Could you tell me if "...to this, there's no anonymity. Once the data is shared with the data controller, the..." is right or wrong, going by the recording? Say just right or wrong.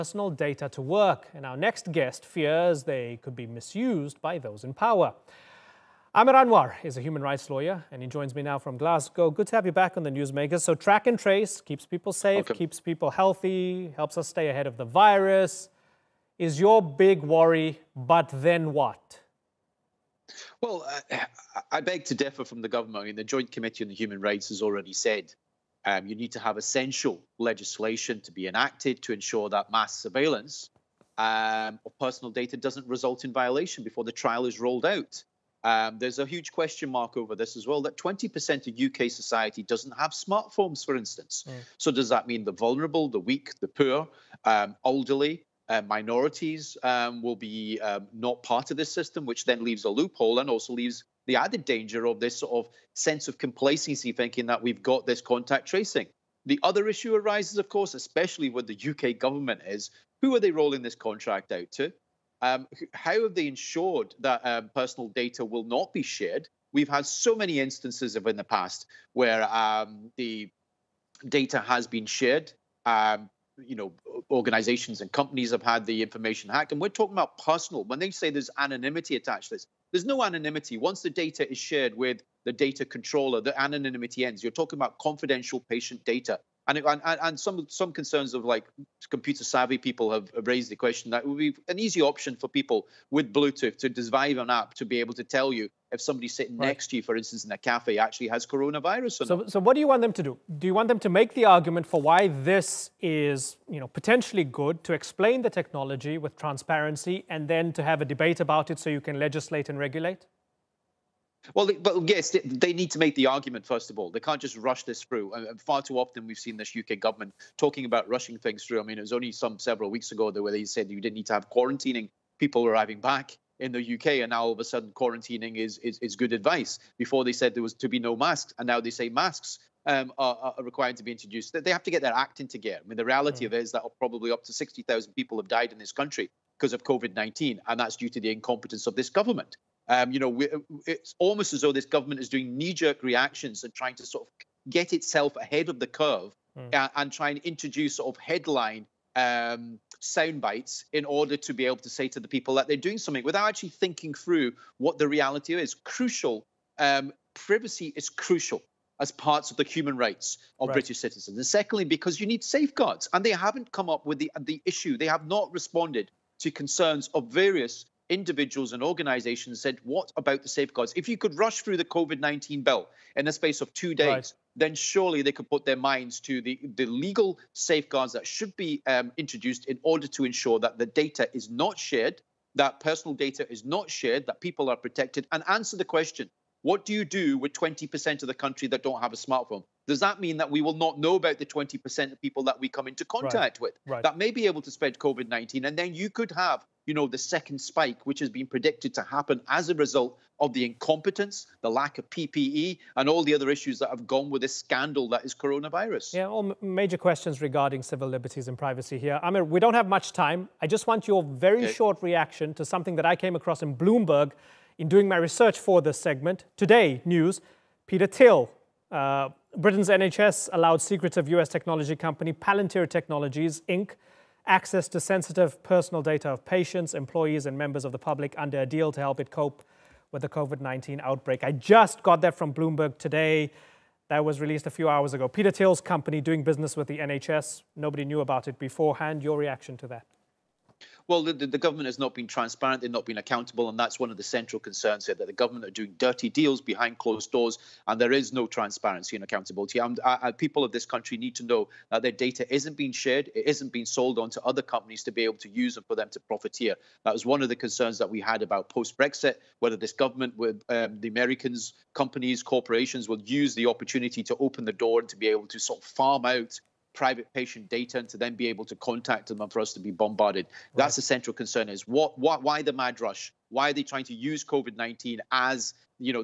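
right.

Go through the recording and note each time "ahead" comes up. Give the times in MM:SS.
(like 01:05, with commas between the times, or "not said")
00:14, 02:25.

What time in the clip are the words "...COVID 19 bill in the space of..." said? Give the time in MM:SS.
02:51.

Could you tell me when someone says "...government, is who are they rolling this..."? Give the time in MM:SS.
00:59.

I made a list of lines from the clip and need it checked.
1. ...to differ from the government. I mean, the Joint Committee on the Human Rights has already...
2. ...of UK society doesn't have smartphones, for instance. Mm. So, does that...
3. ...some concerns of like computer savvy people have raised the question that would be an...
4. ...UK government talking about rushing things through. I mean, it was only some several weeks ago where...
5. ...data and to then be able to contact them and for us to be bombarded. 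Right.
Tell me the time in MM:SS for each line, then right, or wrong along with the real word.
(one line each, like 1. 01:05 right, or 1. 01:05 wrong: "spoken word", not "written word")
1. 00:22 right
2. 00:38 right
3. 01:27 right
4. 01:56 right
5. 04:27 right.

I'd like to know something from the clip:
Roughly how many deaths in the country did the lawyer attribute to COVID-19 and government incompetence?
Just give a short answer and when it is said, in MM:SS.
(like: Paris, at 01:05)
60,000, at 02:14.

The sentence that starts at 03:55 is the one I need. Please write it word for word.
Peter Thiel's company doing business with the NHS.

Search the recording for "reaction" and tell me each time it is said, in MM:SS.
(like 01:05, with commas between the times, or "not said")
02:23, 03:32, 03:59.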